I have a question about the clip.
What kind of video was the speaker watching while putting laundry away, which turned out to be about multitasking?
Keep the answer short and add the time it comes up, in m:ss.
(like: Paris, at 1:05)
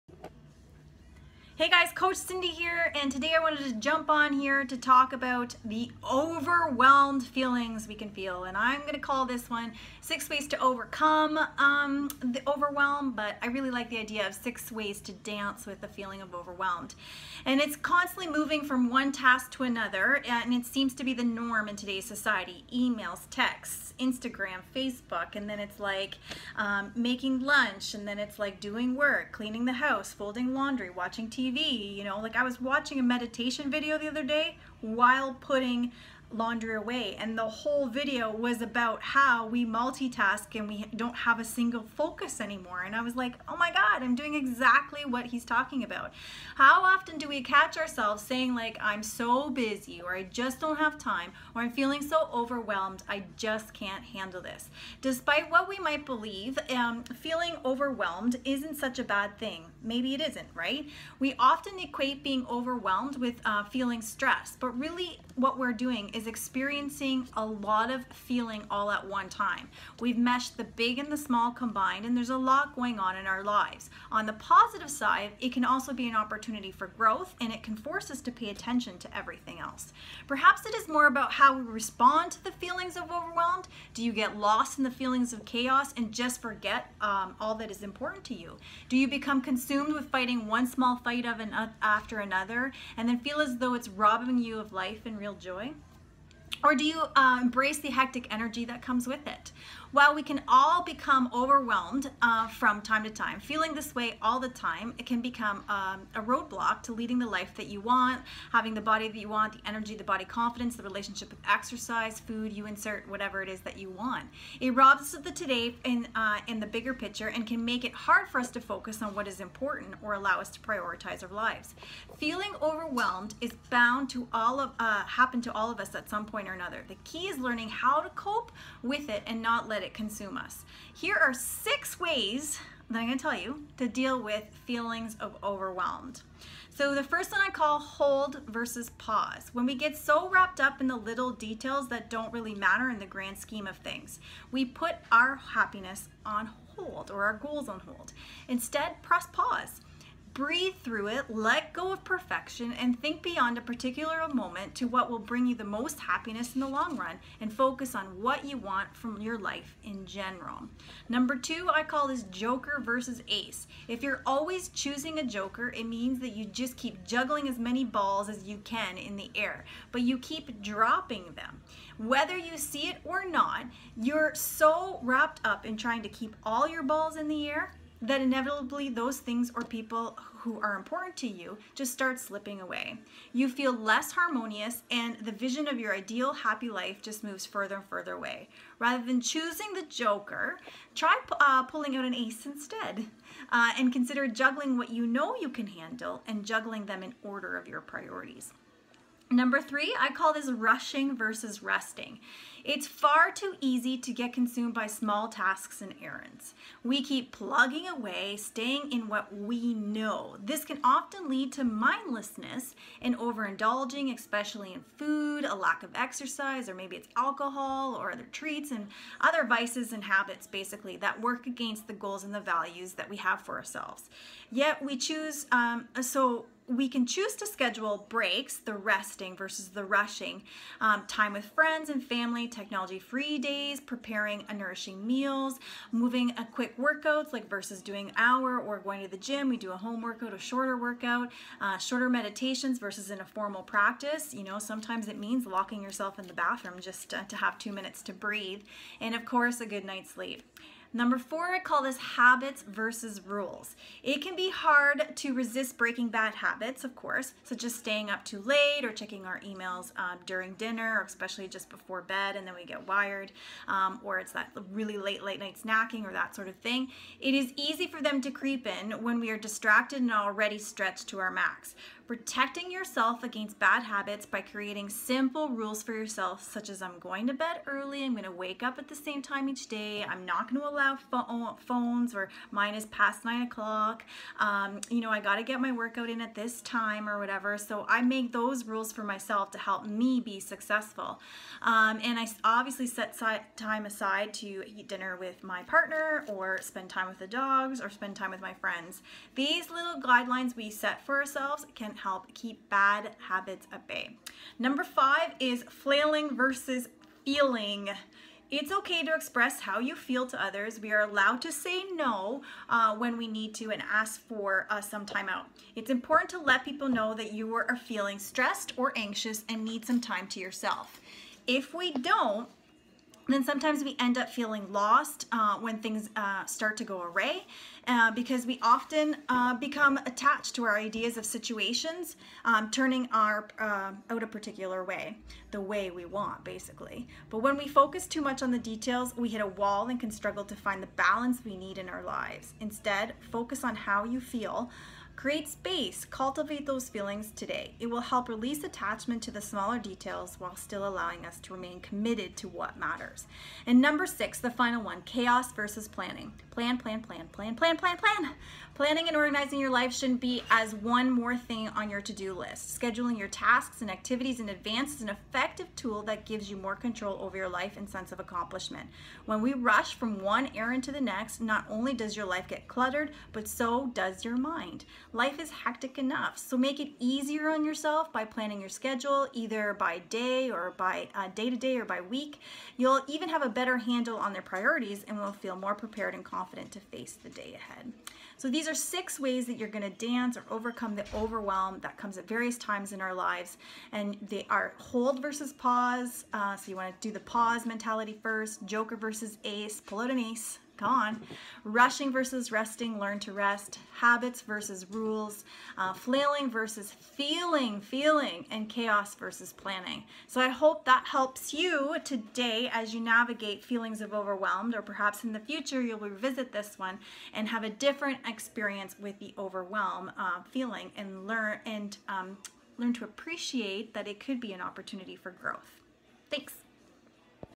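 Meditation video, at 0:33.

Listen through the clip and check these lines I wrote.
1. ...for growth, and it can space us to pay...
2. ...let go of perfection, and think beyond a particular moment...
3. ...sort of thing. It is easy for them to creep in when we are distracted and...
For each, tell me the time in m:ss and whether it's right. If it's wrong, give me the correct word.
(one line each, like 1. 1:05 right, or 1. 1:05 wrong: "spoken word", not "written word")
1. 1:16 wrong: "force", not "space"
2. 2:31 right
3. 4:26 right.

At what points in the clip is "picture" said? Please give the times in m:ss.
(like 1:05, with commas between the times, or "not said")
1:56.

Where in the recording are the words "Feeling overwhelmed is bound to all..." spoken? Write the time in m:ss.
2:02.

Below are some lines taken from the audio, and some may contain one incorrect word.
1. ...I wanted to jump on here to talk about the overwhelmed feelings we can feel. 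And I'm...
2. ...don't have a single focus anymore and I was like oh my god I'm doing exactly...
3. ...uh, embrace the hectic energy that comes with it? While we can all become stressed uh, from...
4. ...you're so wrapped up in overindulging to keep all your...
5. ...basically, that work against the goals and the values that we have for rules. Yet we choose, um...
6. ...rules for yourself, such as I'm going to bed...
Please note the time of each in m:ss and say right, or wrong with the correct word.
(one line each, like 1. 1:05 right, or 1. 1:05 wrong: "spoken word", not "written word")
1. 0:03 right
2. 0:40 right
3. 1:37 wrong: "overwhelmed", not "stressed"
4. 2:53 wrong: "trying", not "overindulging"
5. 3:40 wrong: "ourselves", not "rules"
6. 4:35 right.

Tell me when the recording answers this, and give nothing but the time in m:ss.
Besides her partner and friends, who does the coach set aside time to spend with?
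4:57.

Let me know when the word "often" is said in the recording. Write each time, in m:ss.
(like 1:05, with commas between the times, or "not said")
0:46, 1:01, 3:30, 5:28.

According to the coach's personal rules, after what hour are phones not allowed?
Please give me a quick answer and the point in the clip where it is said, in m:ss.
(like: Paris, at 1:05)
9 o'clock, at 4:43.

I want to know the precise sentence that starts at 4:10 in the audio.
Number four, I call this habits versus rules.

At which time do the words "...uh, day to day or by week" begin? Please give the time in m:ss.
6:21.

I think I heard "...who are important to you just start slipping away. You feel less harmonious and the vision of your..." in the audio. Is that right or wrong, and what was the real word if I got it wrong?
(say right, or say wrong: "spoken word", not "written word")
right.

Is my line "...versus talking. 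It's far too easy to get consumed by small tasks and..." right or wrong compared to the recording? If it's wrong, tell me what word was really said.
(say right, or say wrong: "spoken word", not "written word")
wrong: "resting", not "talking".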